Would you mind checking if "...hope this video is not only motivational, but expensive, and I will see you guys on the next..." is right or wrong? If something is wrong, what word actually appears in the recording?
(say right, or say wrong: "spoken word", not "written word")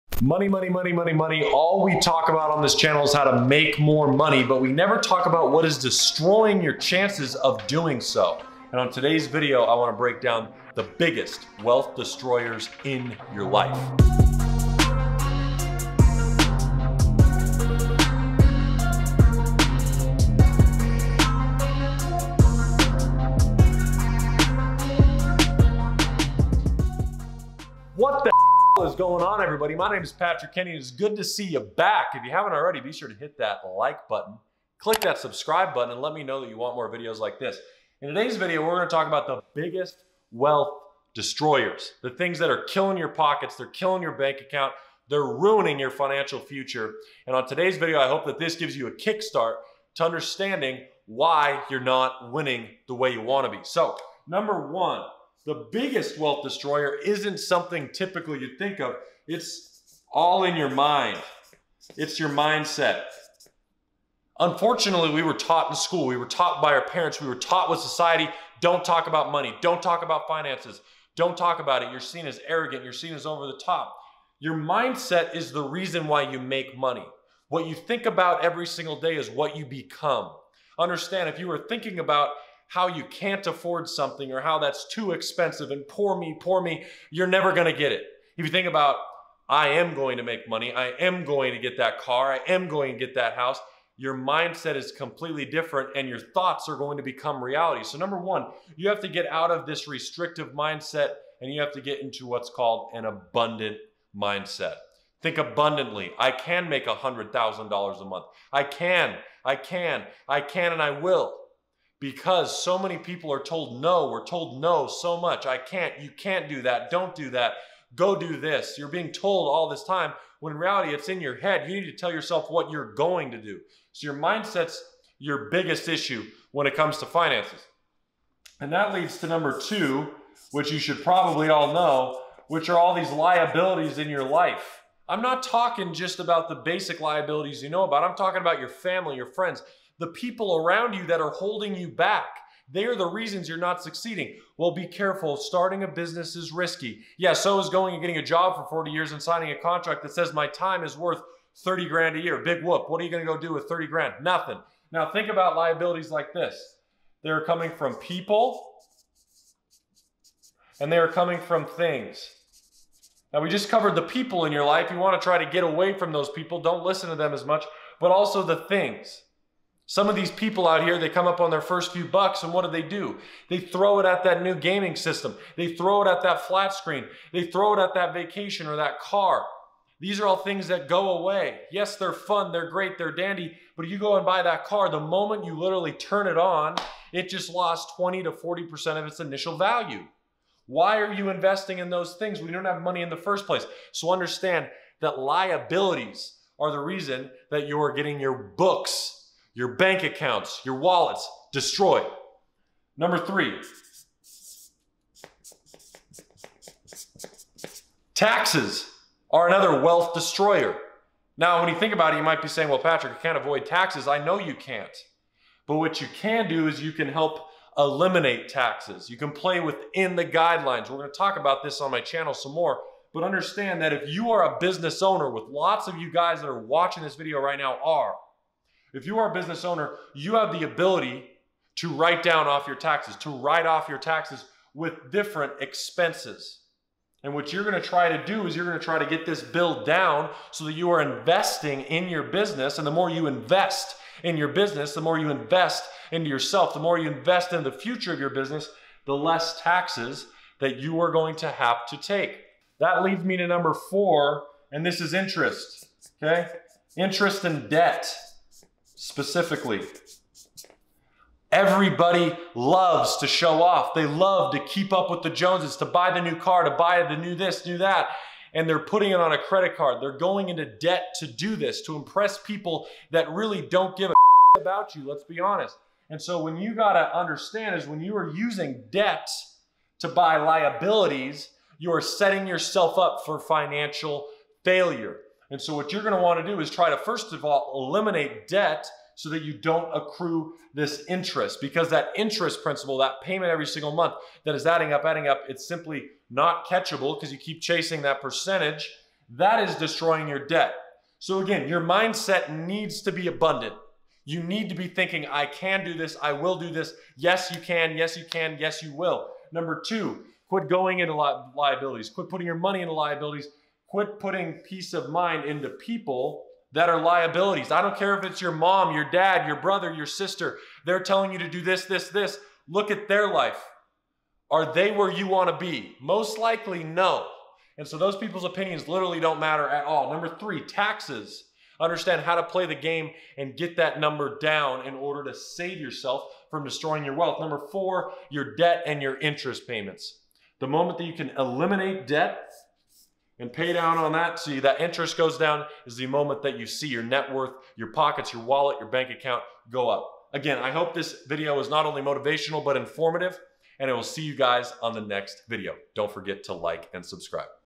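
wrong: "informative", not "expensive".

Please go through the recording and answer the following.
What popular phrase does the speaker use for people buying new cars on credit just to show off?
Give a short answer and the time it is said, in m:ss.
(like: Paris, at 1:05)
keep up with the Joneses, at 4:24.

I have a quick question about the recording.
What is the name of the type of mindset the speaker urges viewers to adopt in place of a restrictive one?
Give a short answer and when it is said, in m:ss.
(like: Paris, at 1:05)
abundant mindset, at 1:43.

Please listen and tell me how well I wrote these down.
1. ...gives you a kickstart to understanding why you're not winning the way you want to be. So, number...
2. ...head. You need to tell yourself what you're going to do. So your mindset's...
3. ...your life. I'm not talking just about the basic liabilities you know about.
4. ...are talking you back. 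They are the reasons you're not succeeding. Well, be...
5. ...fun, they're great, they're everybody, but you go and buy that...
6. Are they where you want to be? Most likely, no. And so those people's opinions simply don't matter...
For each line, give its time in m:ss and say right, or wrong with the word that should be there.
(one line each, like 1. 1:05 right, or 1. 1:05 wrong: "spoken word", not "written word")
1. 0:48 right
2. 2:01 right
3. 2:14 right
4. 2:21 wrong: "holding", not "talking"
5. 3:02 wrong: "dandy", not "everybody"
6. 5:24 wrong: "literally", not "simply".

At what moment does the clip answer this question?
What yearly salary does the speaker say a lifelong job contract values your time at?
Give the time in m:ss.
2:31.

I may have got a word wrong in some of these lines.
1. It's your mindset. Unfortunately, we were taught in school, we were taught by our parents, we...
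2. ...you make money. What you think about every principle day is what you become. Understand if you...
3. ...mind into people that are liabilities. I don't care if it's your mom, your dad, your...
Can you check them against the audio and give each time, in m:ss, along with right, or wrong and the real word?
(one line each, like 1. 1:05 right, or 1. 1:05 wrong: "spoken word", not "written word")
1. 1:01 right
2. 1:16 wrong: "single", not "principle"
3. 5:15 right.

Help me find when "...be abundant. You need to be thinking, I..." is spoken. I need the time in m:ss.
5:03.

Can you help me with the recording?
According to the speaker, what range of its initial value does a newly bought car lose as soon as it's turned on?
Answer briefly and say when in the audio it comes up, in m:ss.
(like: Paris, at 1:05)
20 to 40%, at 3:07.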